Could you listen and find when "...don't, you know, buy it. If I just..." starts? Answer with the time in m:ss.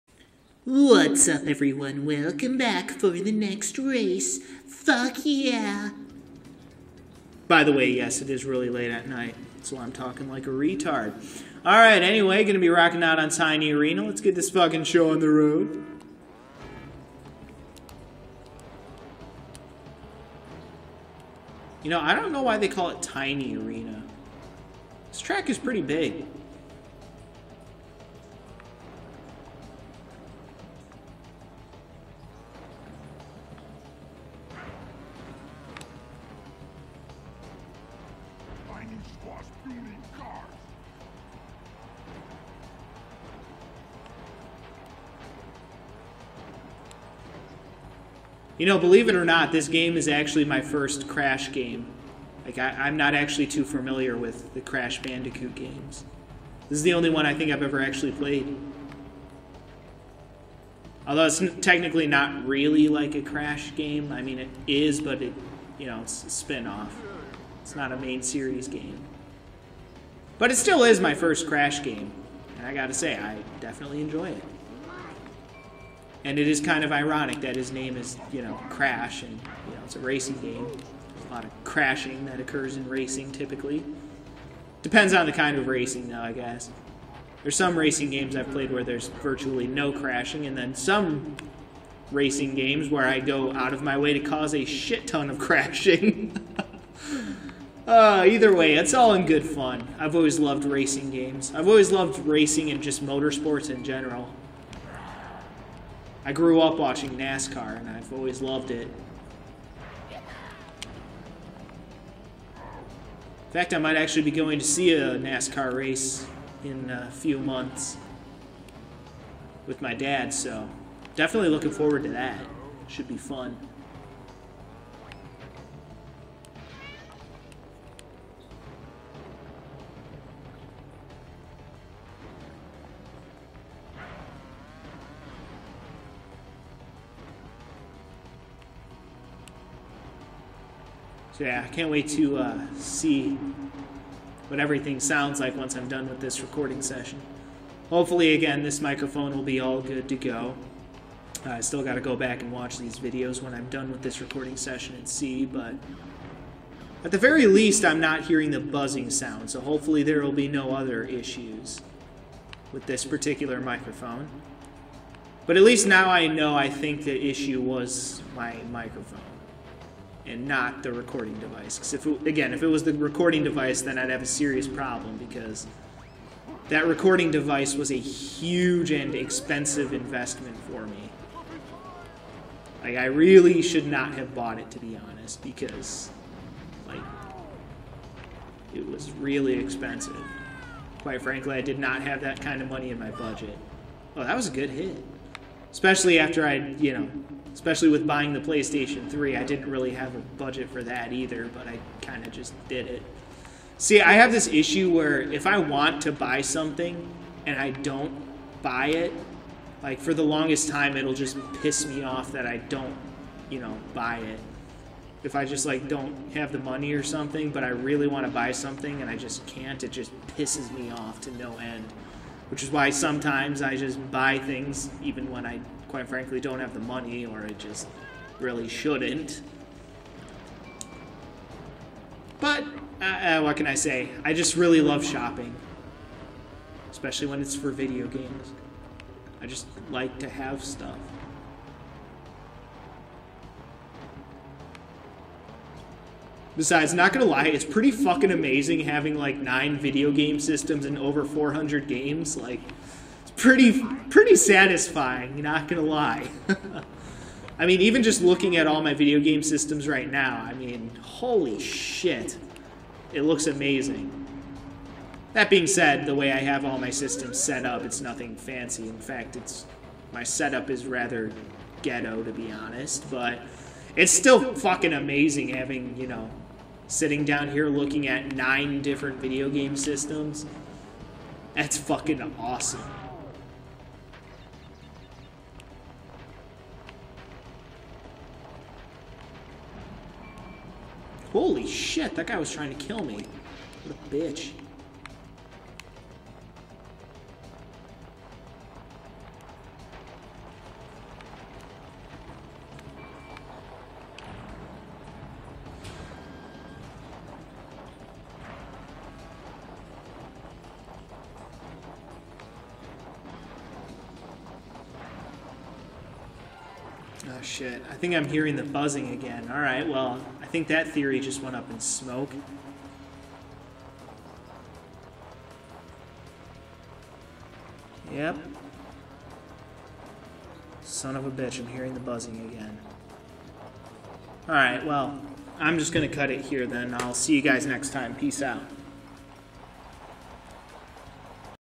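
3:32.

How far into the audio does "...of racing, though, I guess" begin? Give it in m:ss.
1:25.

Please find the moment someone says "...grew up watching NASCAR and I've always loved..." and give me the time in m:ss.
1:46.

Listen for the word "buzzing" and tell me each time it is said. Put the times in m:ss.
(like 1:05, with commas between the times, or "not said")
2:38, 5:18, 5:31.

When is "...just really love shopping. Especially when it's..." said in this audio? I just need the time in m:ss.
3:54.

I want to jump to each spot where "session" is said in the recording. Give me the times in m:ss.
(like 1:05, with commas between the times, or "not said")
2:26, 2:34.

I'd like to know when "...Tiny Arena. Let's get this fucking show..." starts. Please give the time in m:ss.
0:13.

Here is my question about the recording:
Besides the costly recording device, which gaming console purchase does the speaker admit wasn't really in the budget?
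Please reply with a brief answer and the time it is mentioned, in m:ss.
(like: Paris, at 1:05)
PlayStation 3, at 3:18.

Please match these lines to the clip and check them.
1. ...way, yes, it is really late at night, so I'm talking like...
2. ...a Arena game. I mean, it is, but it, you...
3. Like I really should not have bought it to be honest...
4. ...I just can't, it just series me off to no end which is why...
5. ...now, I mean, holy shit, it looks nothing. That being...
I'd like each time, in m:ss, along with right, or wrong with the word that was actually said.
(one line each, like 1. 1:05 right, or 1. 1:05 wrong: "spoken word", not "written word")
1. 0:07 right
2. 1:03 wrong: "Crash", not "Arena"
3. 3:02 right
4. 3:39 wrong: "pisses", not "series"
5. 4:20 wrong: "amazing", not "nothing".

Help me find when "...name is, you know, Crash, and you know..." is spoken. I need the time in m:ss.
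1:17.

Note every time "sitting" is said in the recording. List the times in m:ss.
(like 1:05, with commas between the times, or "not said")
4:36.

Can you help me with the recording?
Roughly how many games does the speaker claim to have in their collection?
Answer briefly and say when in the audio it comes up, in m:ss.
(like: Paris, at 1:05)
Over 400, at 4:10.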